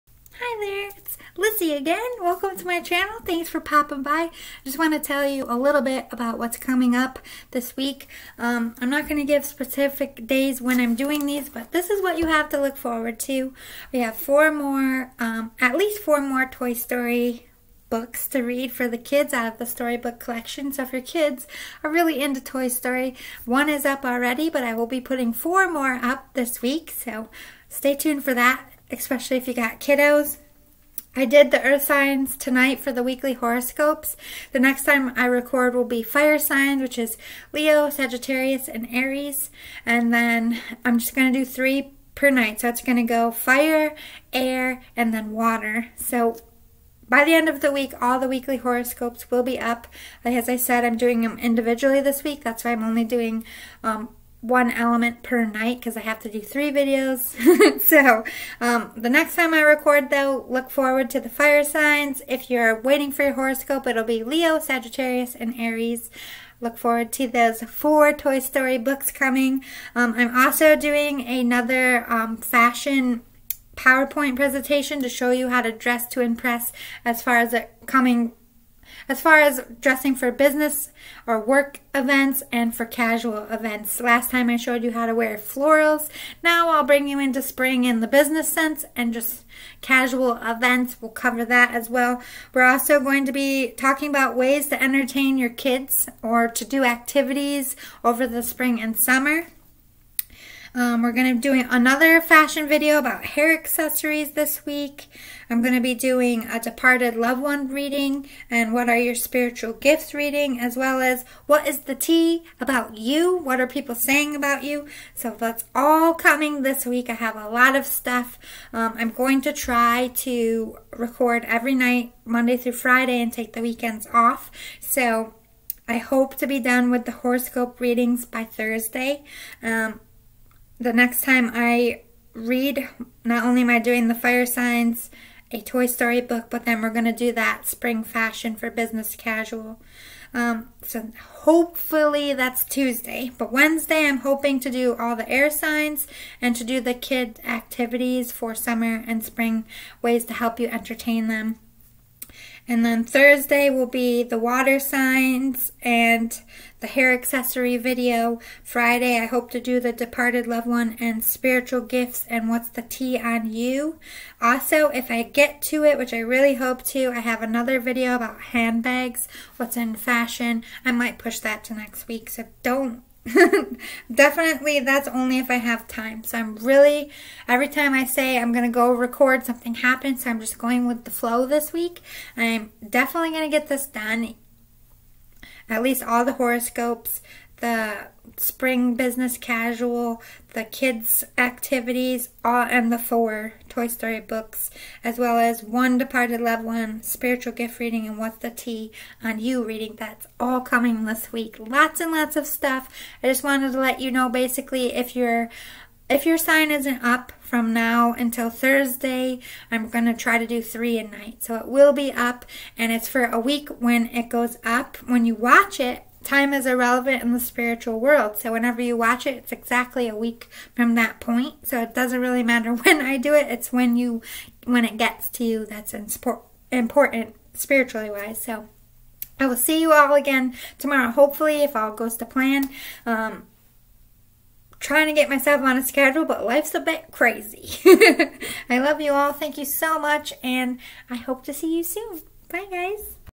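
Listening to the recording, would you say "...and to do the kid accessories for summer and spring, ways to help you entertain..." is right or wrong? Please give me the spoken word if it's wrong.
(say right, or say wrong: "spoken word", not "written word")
wrong: "activities", not "accessories".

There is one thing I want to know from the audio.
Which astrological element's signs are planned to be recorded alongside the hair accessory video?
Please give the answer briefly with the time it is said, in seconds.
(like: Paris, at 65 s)
Water signs, at 154 s.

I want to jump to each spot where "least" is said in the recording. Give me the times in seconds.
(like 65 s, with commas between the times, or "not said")
15 s, 185 s.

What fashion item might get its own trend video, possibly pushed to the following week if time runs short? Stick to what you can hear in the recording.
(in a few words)
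Handbags.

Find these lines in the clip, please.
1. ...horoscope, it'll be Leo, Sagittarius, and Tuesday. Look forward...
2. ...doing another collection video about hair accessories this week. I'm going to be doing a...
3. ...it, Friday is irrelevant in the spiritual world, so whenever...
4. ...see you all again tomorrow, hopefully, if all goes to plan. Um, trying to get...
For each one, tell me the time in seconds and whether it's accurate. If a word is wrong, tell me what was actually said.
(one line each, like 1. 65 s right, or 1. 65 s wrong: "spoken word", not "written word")
1. 63 s wrong: "Aries", not "Tuesday"
2. 101 s wrong: "fashion", not "collection"
3. 215 s wrong: "Time", not "Friday"
4. 229 s right.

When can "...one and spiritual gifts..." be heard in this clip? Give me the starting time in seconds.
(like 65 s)
160 s.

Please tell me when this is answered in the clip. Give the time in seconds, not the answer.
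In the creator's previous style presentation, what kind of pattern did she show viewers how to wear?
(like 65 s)
85 s.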